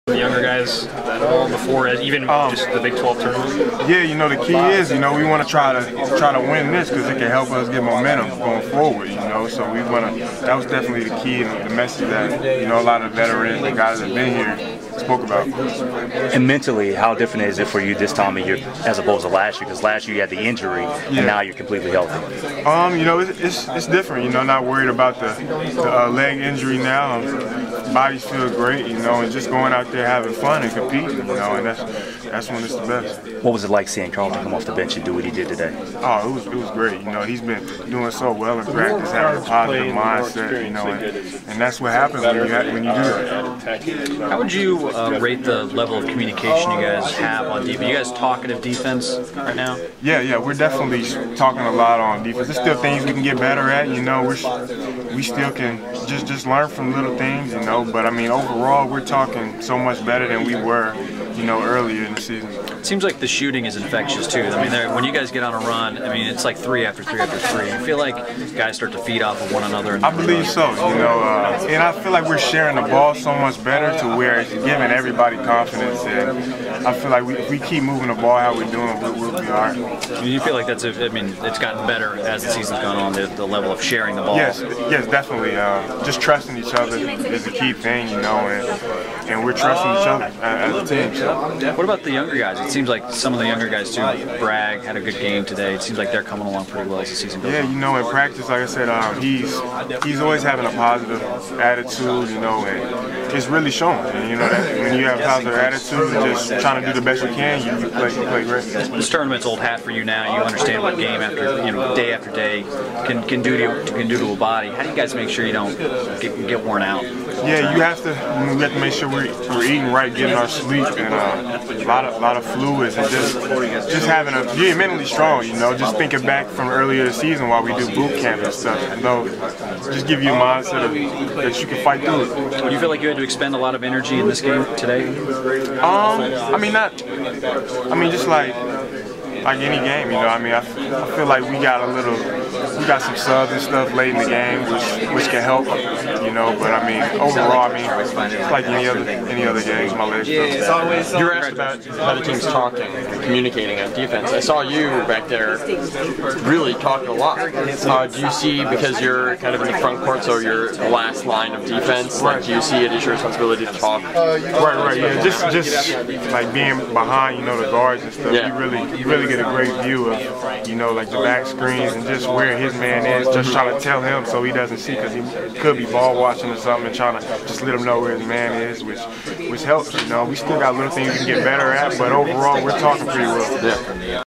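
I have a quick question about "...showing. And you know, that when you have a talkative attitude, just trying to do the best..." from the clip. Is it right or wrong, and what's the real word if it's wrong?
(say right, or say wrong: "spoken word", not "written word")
wrong: "positive", not "talkative".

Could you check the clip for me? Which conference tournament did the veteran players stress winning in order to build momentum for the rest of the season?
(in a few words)
Big 12 tournament.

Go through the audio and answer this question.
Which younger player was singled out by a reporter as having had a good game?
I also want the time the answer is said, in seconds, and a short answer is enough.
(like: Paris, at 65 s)
Bragg, at 94 s.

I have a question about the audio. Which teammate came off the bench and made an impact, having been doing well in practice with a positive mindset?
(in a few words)
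Carlton.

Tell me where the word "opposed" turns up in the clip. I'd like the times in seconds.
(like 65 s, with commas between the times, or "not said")
18 s.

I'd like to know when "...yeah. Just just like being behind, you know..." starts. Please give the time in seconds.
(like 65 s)
164 s.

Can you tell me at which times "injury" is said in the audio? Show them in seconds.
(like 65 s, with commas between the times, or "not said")
20 s, 26 s.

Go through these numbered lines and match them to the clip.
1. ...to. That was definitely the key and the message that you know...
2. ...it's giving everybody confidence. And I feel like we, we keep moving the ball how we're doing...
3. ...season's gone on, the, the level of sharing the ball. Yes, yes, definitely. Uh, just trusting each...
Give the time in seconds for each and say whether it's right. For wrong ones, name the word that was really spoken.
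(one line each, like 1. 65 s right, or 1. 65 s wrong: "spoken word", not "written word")
1. 10 s right
2. 74 s right
3. 82 s right.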